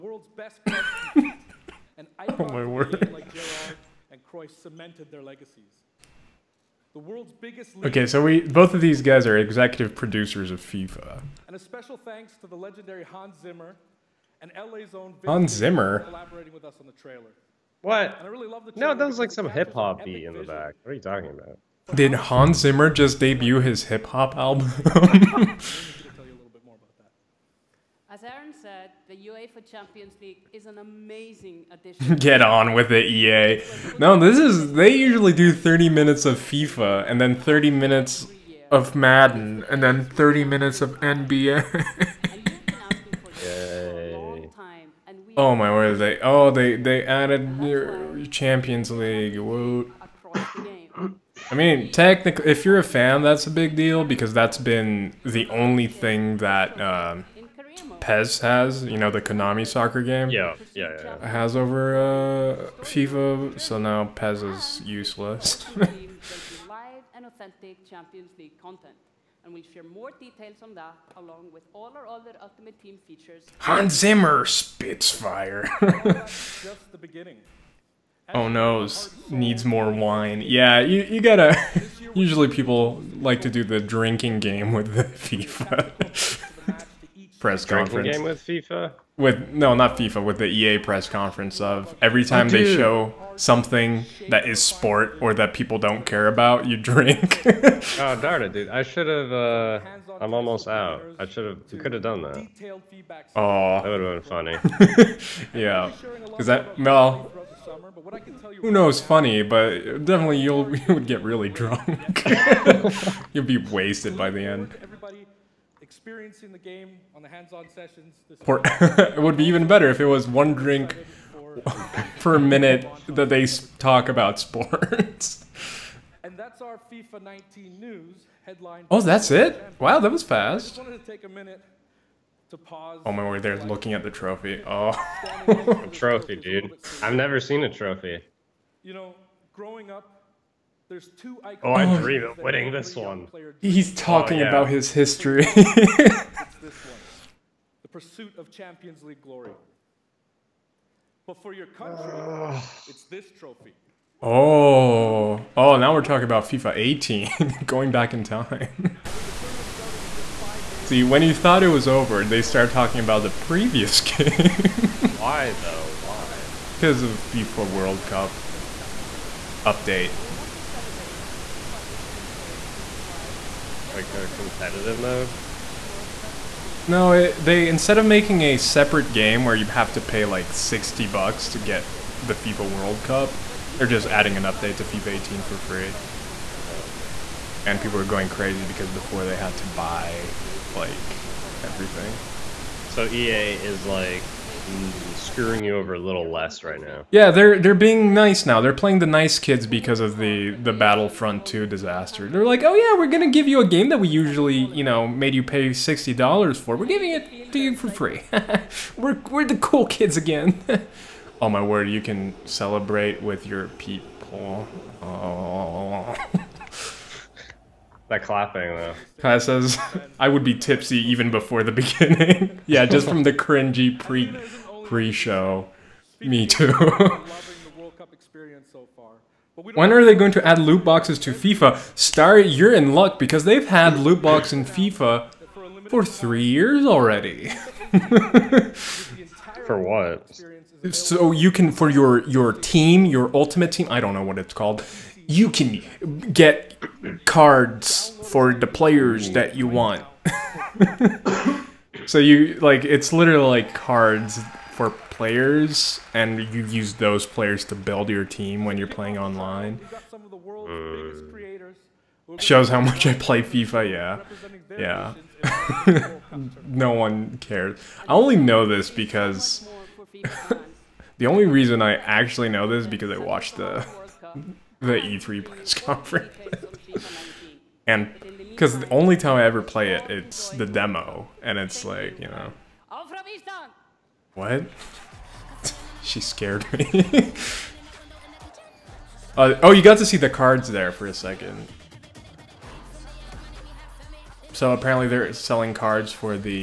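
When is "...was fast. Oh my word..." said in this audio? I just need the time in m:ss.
2:10.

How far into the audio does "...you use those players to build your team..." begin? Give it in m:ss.
4:16.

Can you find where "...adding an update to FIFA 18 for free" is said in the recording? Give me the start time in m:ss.
3:04.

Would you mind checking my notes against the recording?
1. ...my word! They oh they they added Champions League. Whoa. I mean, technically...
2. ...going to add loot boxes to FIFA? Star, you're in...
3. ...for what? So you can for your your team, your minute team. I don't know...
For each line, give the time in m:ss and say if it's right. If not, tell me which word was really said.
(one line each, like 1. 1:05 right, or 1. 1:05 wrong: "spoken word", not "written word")
1. 0:45 right
2. 3:50 right
3. 3:59 wrong: "ultimate", not "minute".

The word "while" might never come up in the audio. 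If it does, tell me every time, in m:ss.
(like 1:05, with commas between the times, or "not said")
not said.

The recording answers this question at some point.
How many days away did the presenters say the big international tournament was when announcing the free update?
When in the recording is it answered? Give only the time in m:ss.
2:40.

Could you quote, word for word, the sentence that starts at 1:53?
You'll be wasted by the end experiencing the game on the hands-on sessions.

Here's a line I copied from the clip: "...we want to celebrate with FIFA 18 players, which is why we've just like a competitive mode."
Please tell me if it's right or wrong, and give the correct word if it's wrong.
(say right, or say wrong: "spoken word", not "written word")
right.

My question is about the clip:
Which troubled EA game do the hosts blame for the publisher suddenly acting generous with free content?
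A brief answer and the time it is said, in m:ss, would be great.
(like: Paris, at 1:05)
Battlefront 2, at 3:20.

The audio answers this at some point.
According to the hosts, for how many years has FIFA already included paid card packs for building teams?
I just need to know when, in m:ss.
3:56.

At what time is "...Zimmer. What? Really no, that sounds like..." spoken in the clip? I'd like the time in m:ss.
0:15.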